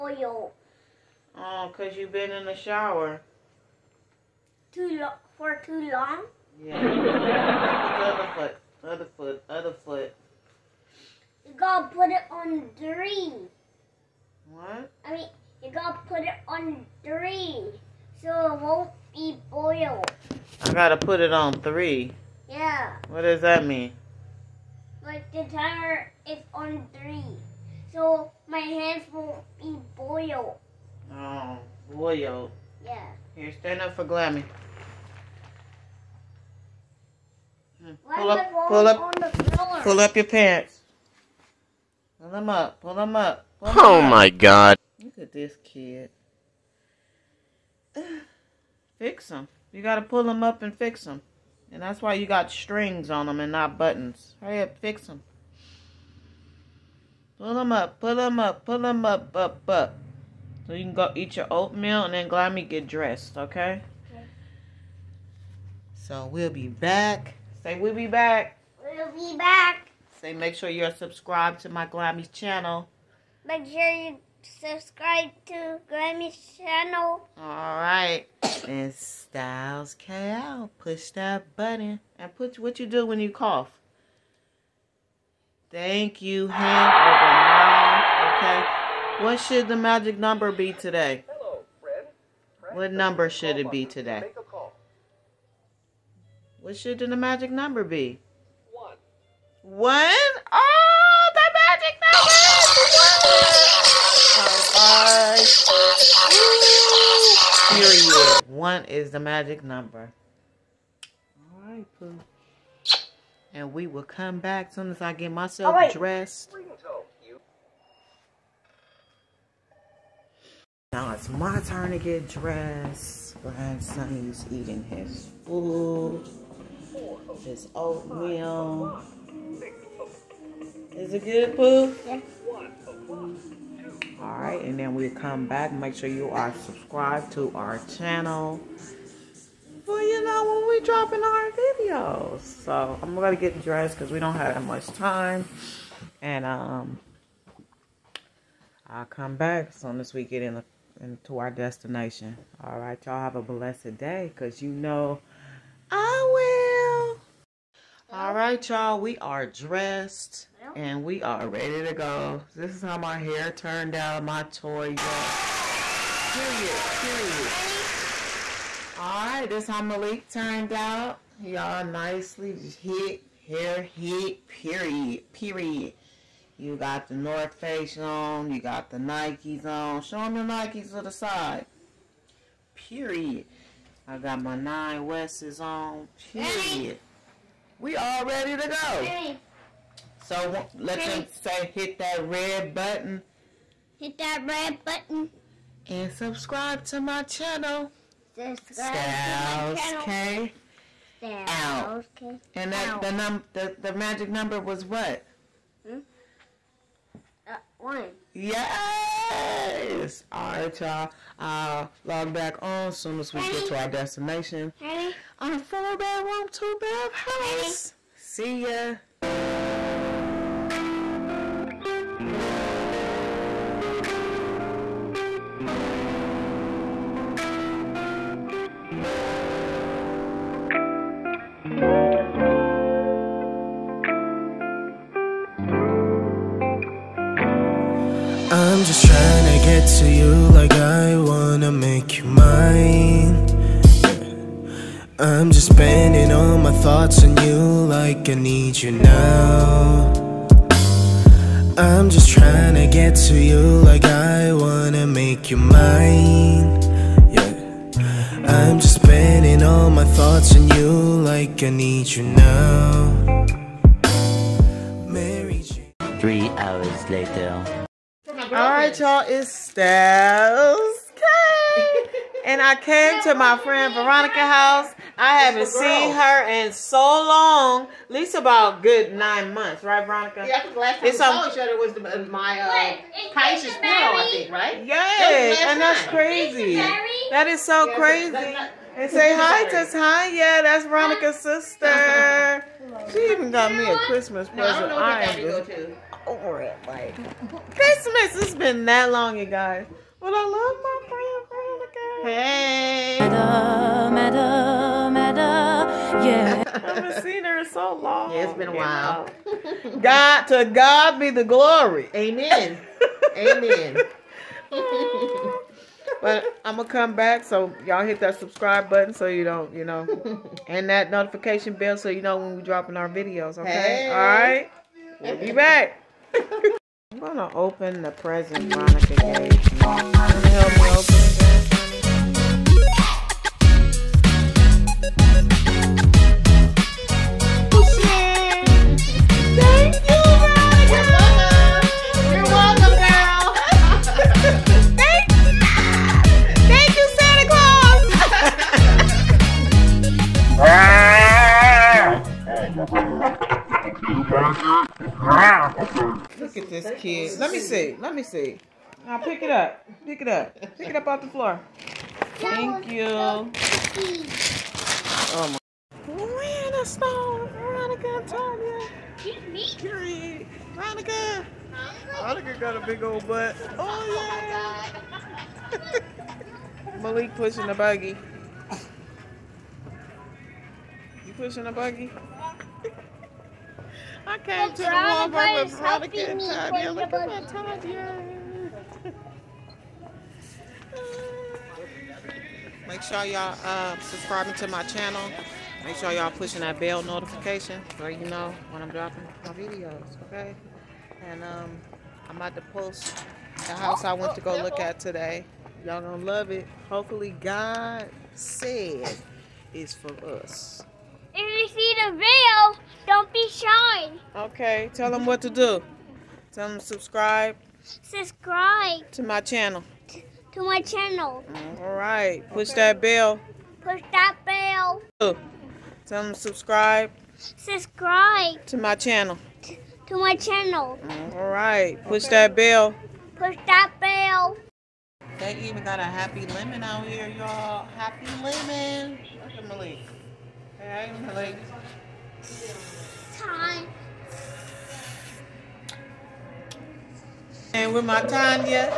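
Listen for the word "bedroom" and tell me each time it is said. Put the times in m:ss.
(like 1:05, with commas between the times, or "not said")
3:35.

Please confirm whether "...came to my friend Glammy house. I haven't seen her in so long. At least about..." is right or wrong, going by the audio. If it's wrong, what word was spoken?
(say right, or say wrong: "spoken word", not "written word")
wrong: "Veronica", not "Glammy".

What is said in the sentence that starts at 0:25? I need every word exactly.
Like the timer is on three, so my hands won't be boiled.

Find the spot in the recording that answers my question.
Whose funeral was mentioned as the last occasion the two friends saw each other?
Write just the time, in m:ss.
4:43.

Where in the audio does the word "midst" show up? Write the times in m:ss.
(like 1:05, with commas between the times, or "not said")
not said.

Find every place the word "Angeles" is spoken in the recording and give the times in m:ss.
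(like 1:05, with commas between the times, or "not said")
not said.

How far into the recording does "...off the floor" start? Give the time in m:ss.
6:01.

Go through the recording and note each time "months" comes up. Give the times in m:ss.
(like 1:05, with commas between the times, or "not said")
4:39.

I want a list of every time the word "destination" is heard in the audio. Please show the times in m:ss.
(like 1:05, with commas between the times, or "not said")
2:31, 3:33.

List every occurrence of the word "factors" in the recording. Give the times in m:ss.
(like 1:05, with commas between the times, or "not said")
not said.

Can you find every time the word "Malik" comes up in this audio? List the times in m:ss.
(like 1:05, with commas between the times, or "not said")
2:49, 6:17, 7:19.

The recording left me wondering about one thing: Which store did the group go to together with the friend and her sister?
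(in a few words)
Walmart.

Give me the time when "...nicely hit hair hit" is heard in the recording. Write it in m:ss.
2:51.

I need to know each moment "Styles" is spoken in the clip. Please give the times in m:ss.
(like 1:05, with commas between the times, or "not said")
1:18, 4:29.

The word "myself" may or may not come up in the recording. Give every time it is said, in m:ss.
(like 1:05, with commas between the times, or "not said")
1:55.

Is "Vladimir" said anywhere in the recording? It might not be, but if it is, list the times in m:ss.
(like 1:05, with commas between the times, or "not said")
not said.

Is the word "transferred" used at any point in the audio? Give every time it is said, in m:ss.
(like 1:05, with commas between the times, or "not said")
not said.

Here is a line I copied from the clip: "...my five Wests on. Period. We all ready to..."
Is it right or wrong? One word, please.
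wrong.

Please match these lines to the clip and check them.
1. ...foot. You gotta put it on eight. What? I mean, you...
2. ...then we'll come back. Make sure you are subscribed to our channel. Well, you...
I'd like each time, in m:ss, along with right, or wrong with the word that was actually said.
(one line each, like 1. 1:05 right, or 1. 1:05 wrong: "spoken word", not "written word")
1. 0:09 wrong: "three", not "eight"
2. 2:14 right.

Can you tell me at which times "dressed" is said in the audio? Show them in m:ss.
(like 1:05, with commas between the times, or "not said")
1:02, 1:55, 2:02, 2:23, 2:39.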